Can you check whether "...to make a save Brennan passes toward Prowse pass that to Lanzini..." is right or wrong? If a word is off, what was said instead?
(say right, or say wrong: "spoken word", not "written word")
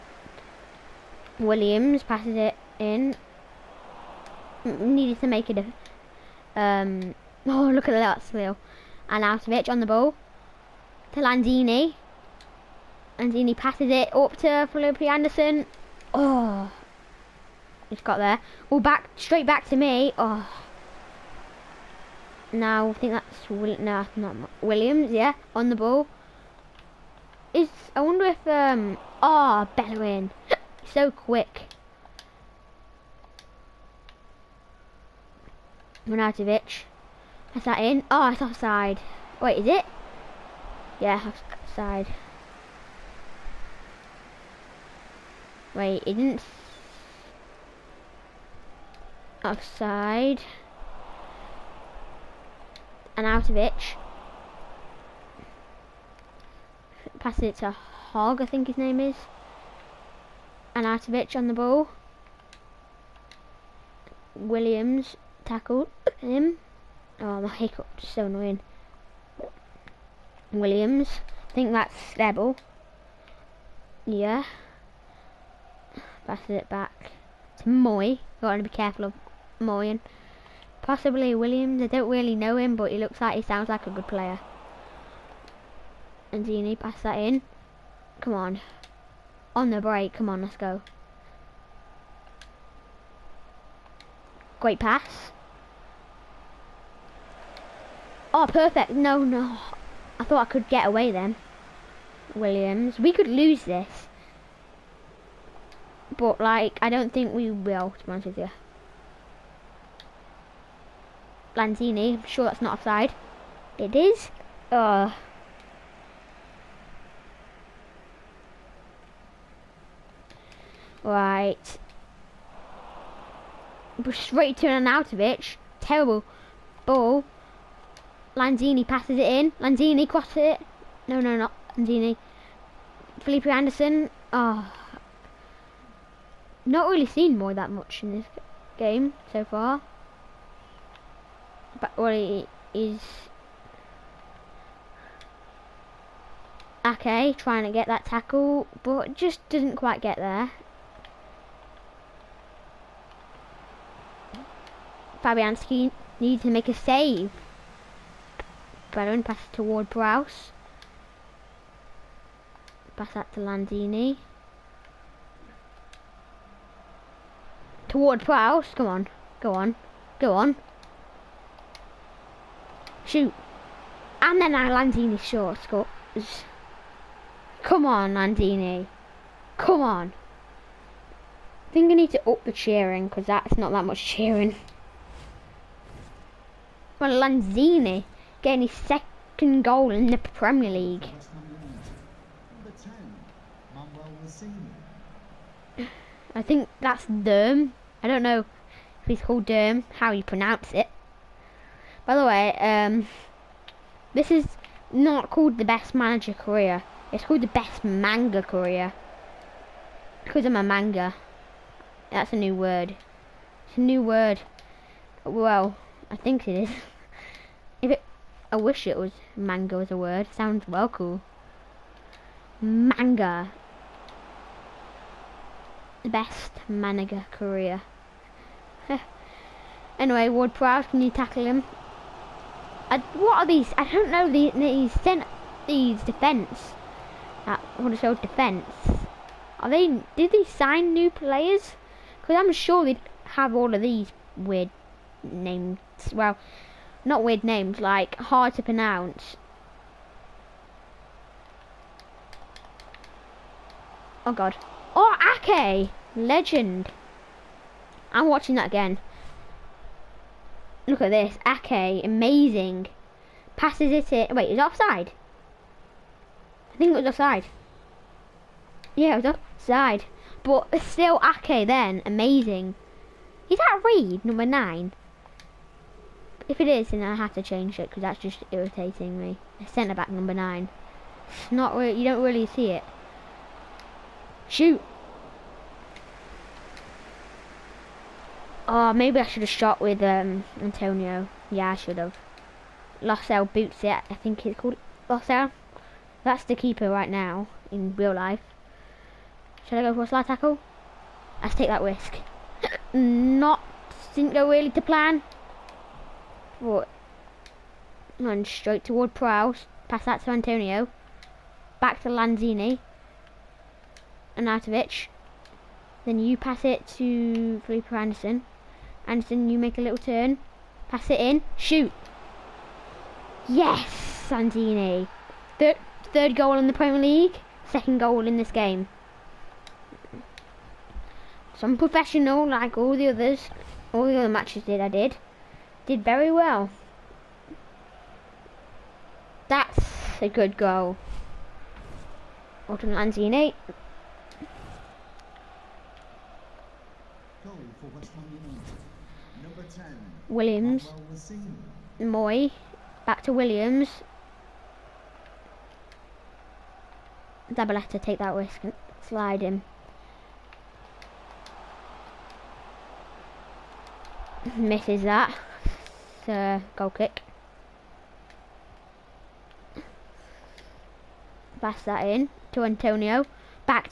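right.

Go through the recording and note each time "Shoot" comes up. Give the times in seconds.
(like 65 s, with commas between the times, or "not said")
173 s, 284 s, 321 s.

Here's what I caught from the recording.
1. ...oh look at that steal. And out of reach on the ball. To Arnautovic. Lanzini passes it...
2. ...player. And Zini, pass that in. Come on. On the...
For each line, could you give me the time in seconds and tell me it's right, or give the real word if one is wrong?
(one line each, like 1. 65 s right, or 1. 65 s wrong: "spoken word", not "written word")
1. 7 s wrong: "Lanzini", not "Arnautovic"
2. 84 s right.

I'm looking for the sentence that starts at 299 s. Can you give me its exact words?
Should I go for a slide tackle?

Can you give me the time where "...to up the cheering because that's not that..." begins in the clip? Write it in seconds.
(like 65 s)
182 s.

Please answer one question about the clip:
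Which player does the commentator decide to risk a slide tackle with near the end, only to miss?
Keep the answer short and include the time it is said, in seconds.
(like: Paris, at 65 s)
Zabaleta, at 357 s.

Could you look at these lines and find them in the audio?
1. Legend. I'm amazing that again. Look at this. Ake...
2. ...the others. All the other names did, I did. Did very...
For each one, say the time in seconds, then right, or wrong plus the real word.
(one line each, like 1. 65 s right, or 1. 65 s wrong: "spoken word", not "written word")
1. 256 s wrong: "watching", not "amazing"
2. 332 s wrong: "matches", not "names".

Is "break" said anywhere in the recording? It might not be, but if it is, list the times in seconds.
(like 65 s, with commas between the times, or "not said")
89 s.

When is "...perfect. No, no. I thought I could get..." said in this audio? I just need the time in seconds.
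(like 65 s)
98 s.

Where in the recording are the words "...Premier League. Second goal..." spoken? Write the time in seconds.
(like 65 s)
326 s.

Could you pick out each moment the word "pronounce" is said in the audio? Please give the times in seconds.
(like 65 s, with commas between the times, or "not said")
200 s, 248 s.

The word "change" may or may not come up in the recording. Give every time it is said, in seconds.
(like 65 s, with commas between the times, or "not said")
277 s.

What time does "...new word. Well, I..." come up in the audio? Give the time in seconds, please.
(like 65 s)
213 s.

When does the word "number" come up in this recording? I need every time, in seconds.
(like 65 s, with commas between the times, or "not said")
274 s, 280 s.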